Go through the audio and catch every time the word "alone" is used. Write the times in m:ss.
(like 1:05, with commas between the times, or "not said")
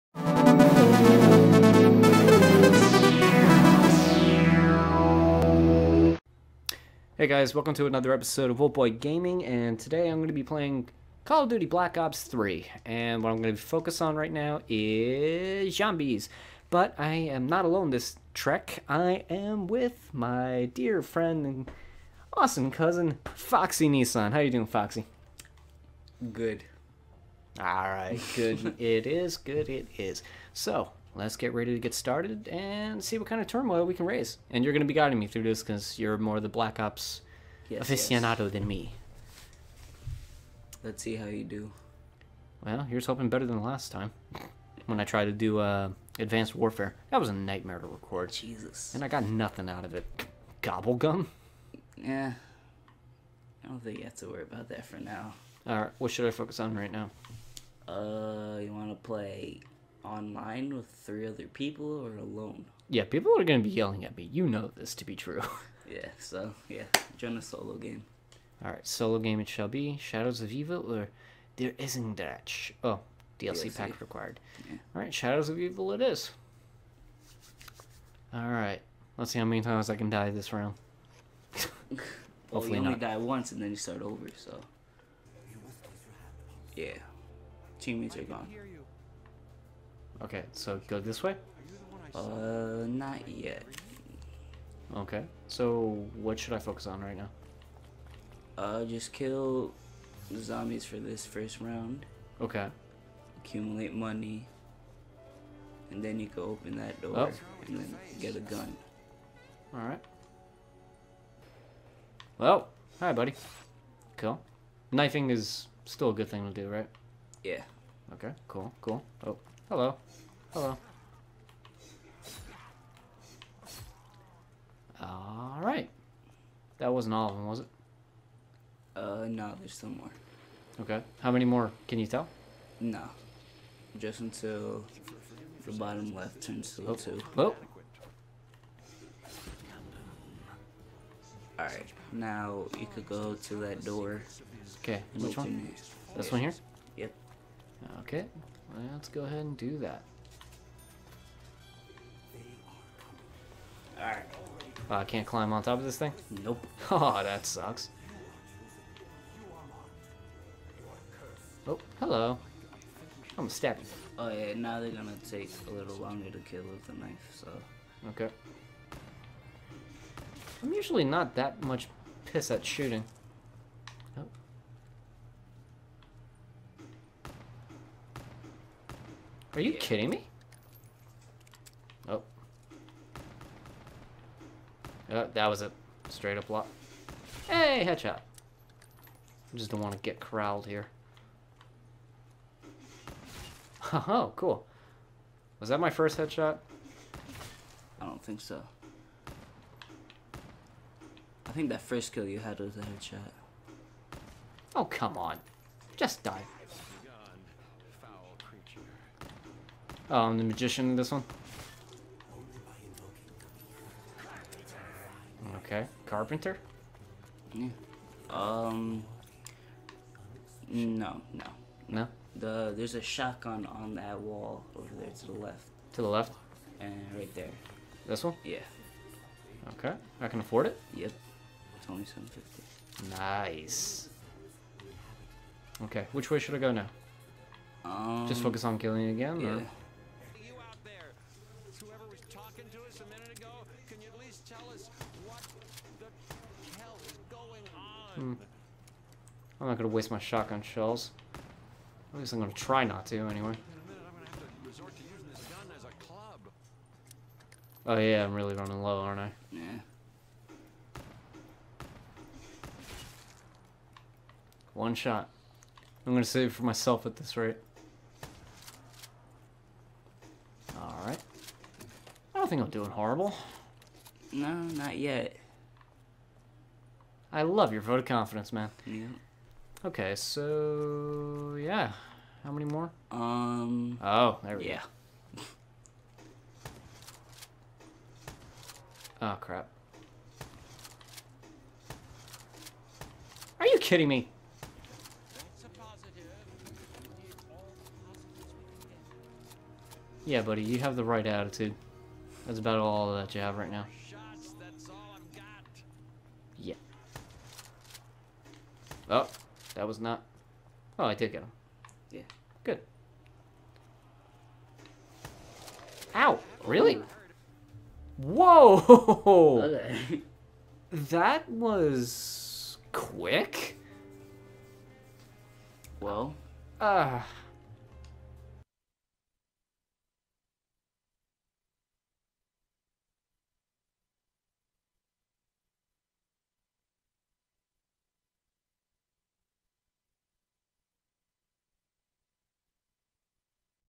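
0:17, 1:02.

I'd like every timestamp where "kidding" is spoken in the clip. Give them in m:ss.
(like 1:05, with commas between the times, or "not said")
2:59, 4:53.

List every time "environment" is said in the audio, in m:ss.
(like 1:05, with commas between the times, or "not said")
not said.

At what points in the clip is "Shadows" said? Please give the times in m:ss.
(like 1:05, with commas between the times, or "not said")
1:09, 1:15.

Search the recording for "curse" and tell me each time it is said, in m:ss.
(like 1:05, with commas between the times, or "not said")
not said.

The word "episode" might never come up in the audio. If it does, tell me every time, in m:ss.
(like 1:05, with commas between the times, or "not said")
0:08.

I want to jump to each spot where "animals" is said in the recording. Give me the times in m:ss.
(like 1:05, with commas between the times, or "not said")
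not said.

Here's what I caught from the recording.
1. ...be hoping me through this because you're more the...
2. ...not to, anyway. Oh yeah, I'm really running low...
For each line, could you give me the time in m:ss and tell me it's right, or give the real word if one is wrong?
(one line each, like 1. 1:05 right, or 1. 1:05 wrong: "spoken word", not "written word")
1. 0:34 wrong: "guiding", not "hoping"
2. 4:12 right.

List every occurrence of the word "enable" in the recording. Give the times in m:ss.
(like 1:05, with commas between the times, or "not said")
not said.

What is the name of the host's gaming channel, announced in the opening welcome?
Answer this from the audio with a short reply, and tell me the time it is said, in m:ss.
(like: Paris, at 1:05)
Wulfboi Gaming, at 0:08.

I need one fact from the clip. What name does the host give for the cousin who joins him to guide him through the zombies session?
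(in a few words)
Foxy Nissan.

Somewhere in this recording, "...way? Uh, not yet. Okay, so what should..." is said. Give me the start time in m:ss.
1:31.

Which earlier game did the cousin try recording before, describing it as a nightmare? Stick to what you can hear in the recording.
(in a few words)
Advanced Warfare.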